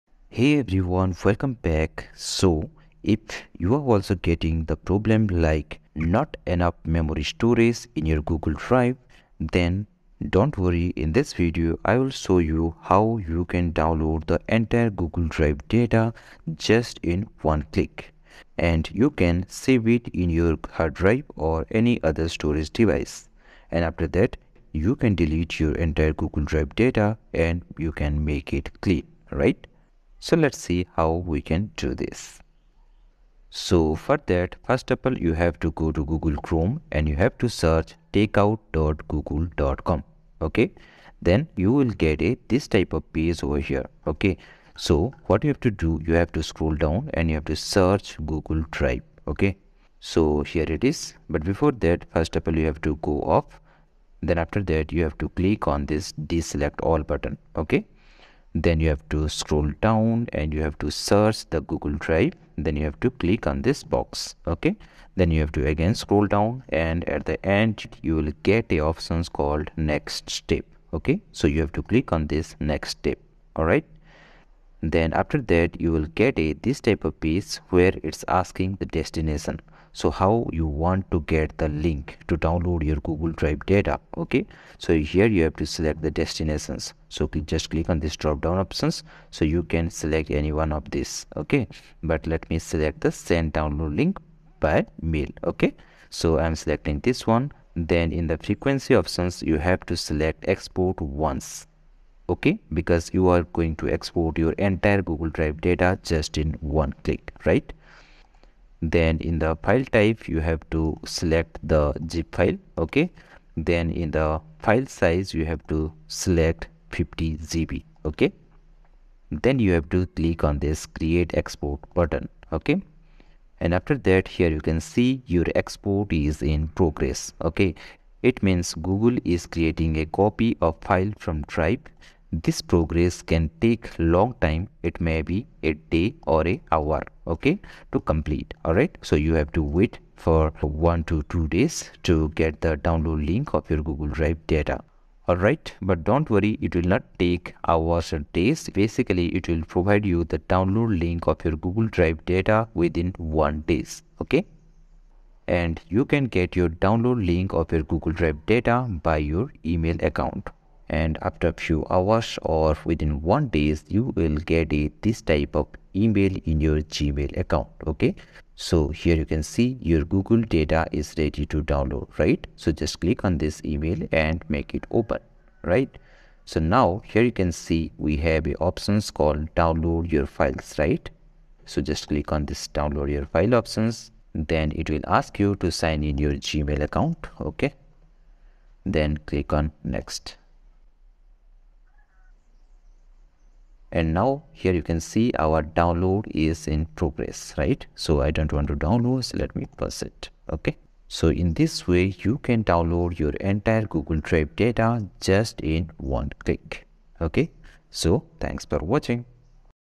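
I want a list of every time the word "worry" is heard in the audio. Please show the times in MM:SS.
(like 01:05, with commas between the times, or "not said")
00:10, 02:26.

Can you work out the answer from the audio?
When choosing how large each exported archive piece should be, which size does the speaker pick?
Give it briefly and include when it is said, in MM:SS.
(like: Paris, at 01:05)
50 GB, at 01:56.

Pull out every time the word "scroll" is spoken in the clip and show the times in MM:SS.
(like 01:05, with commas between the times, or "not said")
00:46, 00:59, 01:05.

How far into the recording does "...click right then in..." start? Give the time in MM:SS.
01:47.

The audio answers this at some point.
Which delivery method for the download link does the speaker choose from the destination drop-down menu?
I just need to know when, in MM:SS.
01:33.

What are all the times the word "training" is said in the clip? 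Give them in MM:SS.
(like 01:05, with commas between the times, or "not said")
not said.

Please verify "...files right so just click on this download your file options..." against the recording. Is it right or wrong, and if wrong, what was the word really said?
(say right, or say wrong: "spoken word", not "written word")
right.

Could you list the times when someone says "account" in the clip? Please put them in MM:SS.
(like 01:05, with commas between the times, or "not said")
02:40, 02:47, 03:06.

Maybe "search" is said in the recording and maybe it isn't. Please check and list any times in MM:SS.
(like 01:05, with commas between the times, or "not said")
00:37, 00:47, 01:00.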